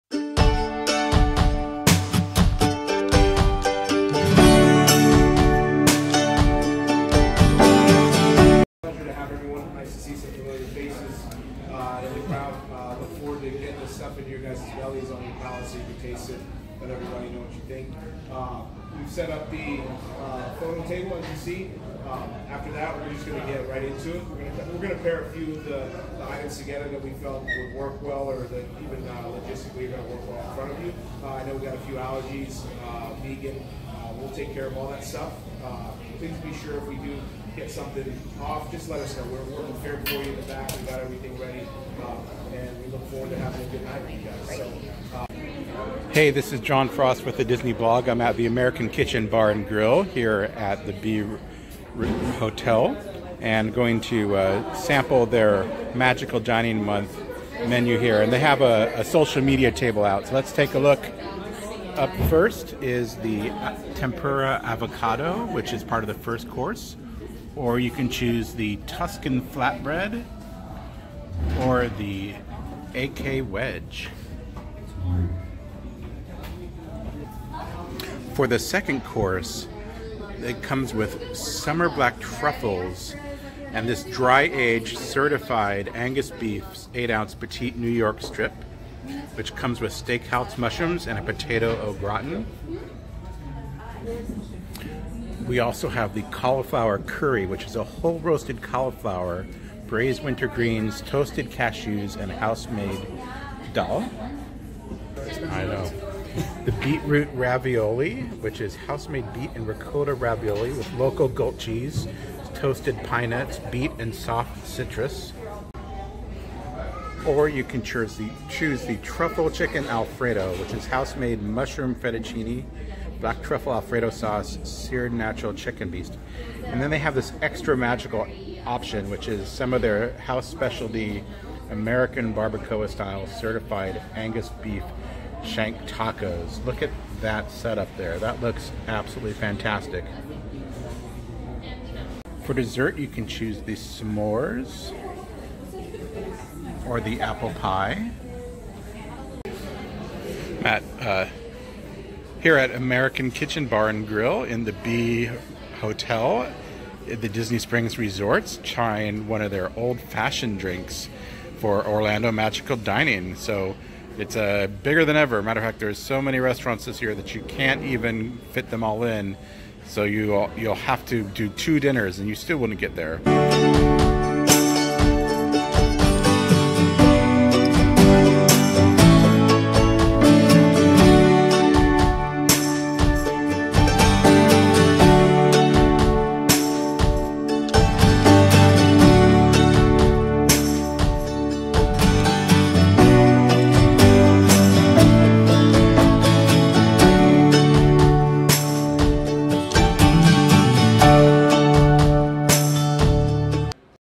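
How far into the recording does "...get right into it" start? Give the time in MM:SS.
00:23.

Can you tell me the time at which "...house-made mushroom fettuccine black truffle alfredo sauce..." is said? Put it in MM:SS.
02:00.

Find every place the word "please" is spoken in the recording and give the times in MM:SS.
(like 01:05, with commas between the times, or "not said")
00:36.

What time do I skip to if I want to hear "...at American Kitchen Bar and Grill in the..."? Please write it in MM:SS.
02:32.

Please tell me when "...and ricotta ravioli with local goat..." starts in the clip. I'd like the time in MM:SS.
01:49.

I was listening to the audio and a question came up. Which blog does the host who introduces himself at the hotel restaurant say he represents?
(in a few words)
The Disney Blog.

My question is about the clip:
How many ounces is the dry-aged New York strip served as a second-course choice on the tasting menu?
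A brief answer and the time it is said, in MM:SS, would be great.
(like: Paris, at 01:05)
8, at 01:26.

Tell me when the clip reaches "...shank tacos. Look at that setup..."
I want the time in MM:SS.
02:15.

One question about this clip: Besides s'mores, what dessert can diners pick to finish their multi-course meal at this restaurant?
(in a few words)
Apple pie.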